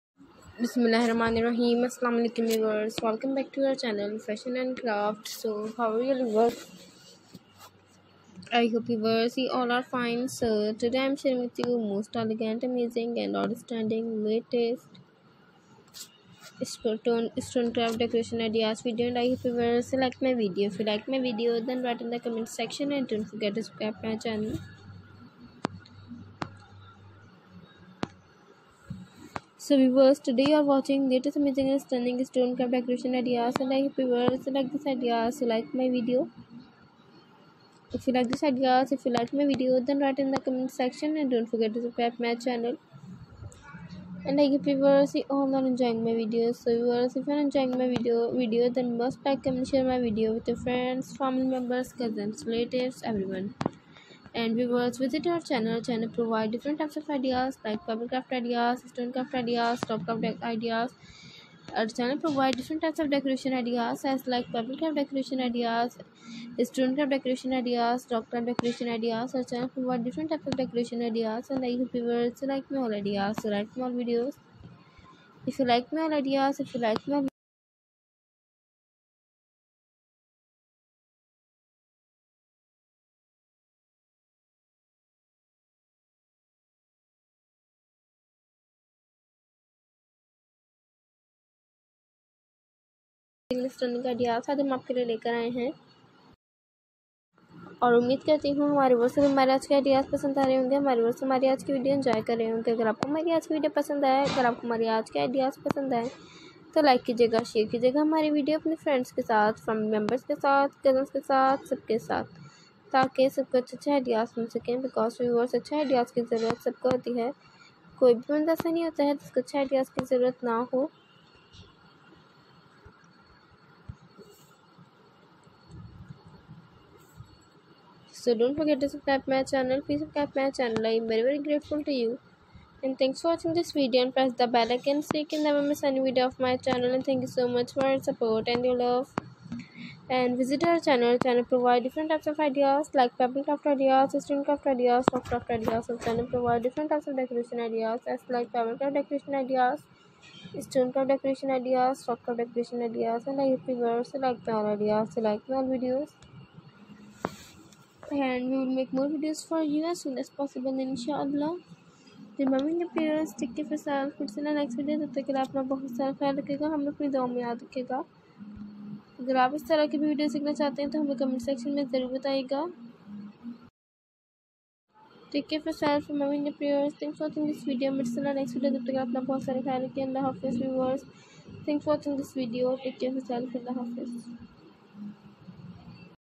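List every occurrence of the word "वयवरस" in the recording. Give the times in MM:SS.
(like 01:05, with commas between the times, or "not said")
01:55, 03:00.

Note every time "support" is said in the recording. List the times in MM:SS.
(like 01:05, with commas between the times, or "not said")
02:18.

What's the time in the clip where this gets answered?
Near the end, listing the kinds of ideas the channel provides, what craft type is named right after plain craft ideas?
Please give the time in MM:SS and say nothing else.
02:24.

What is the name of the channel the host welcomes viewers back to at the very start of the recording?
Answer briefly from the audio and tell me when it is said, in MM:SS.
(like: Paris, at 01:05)
Fashion and Craft, at 00:04.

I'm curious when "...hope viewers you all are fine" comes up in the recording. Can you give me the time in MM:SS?
00:08.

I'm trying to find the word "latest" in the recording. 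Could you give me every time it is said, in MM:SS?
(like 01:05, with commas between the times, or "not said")
00:14, 00:31.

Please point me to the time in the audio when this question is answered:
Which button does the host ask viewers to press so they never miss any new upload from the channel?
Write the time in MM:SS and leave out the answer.
02:14.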